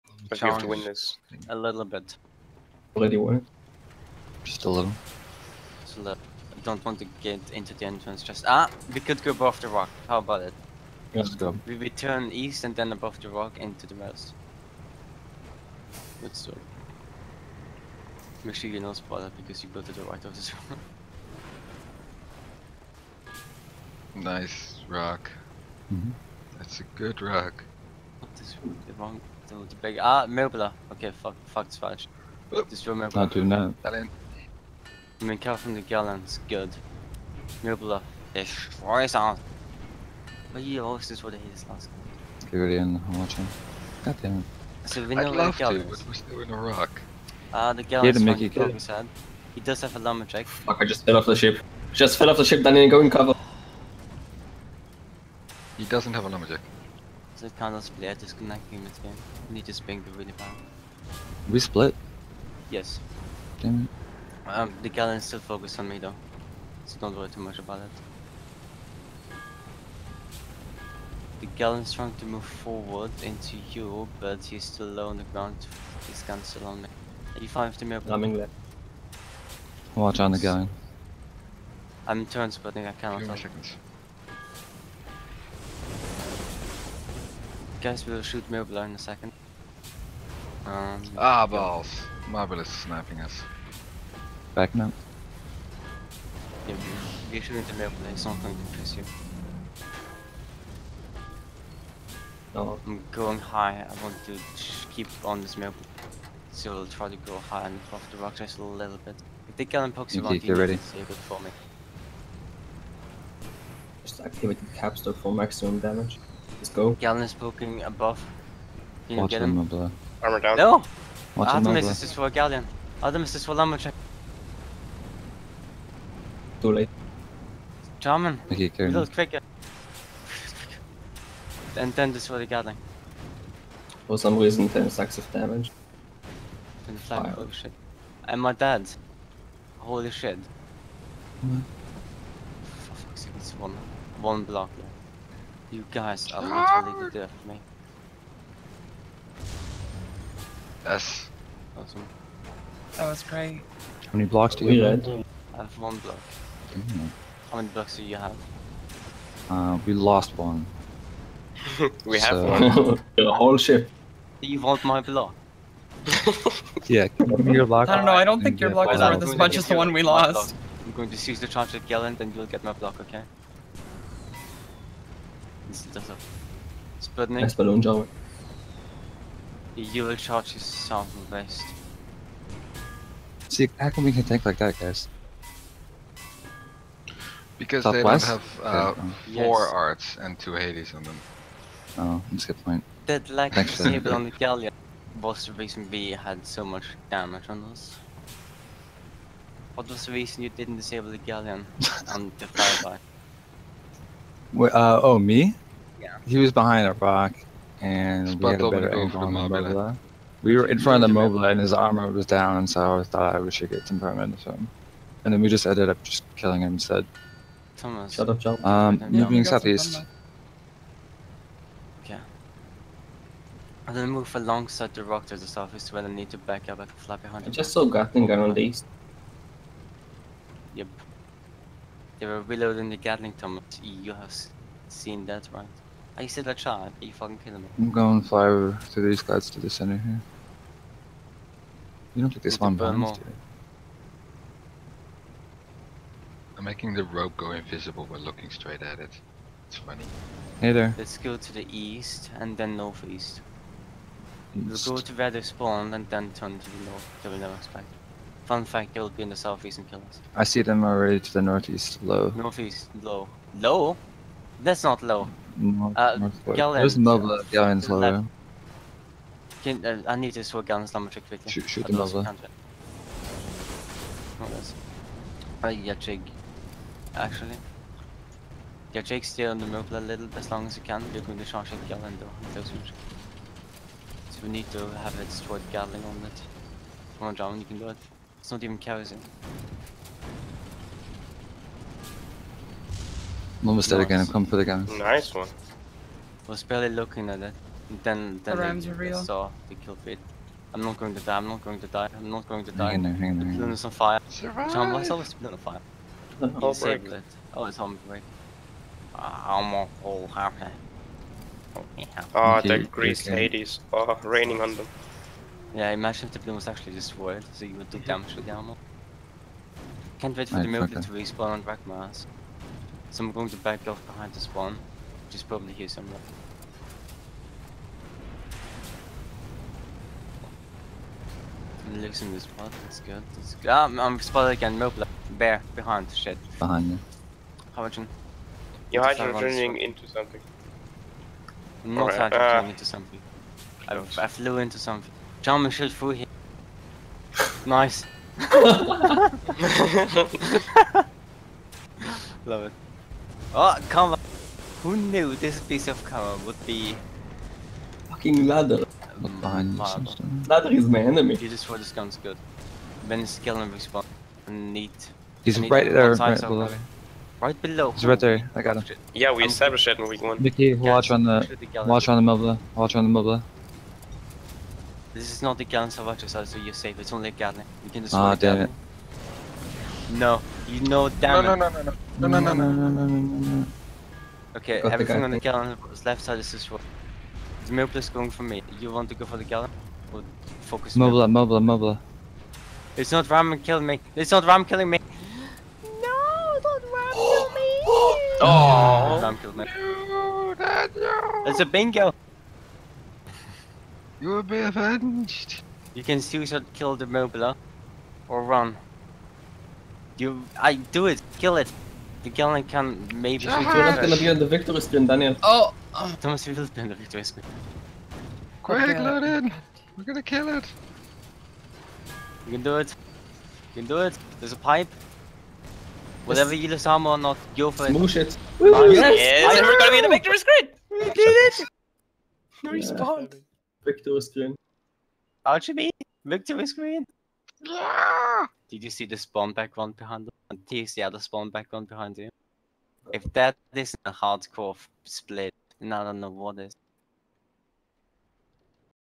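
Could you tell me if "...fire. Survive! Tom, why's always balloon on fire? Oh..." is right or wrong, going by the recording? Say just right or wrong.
right.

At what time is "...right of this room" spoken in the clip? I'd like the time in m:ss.
0:20.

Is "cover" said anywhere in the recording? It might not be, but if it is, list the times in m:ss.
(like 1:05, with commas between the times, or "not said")
0:53, 5:56.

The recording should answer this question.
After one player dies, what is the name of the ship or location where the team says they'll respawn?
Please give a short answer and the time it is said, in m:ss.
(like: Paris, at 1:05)
Ragnaros, at 5:21.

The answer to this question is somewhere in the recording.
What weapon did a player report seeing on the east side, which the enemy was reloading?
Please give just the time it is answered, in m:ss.
3:47.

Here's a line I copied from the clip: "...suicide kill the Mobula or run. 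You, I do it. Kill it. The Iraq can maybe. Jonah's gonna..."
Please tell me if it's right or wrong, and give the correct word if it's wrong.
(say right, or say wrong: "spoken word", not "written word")
wrong: "Galleon", not "Iraq".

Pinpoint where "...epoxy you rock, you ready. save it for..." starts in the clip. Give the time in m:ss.
1:49.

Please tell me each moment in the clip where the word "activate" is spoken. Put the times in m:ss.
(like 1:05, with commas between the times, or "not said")
1:54.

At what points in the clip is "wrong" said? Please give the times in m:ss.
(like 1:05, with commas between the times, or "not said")
0:28.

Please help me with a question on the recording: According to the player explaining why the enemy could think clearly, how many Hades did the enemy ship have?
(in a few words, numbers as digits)
2.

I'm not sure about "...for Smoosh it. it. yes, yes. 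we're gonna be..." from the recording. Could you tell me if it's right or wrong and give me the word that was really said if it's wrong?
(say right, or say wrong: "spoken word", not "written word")
right.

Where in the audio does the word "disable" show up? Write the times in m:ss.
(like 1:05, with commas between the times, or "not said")
3:13, 3:20.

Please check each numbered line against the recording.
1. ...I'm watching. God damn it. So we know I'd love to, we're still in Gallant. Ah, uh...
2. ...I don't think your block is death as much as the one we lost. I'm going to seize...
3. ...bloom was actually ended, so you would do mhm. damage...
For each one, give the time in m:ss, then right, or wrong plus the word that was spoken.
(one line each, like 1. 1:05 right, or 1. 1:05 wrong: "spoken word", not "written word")
1. 0:43 wrong: "Iraq", not "Gallant"
2. 2:48 wrong: "worth", not "death"
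3. 5:16 wrong: "destroyed", not "ended".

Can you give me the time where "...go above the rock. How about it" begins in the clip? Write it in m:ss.
0:09.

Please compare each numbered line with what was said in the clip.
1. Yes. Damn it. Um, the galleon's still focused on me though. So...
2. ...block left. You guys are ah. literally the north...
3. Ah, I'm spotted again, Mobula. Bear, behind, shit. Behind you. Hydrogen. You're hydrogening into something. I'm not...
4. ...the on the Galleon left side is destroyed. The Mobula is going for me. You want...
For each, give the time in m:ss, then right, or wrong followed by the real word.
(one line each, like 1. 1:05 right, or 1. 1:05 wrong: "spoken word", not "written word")
1. 1:02 right
2. 2:24 wrong: "death", not "north"
3. 5:33 right
4. 6:25 right.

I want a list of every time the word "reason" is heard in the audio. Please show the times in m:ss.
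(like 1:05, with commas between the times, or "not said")
2:14, 3:15, 3:20.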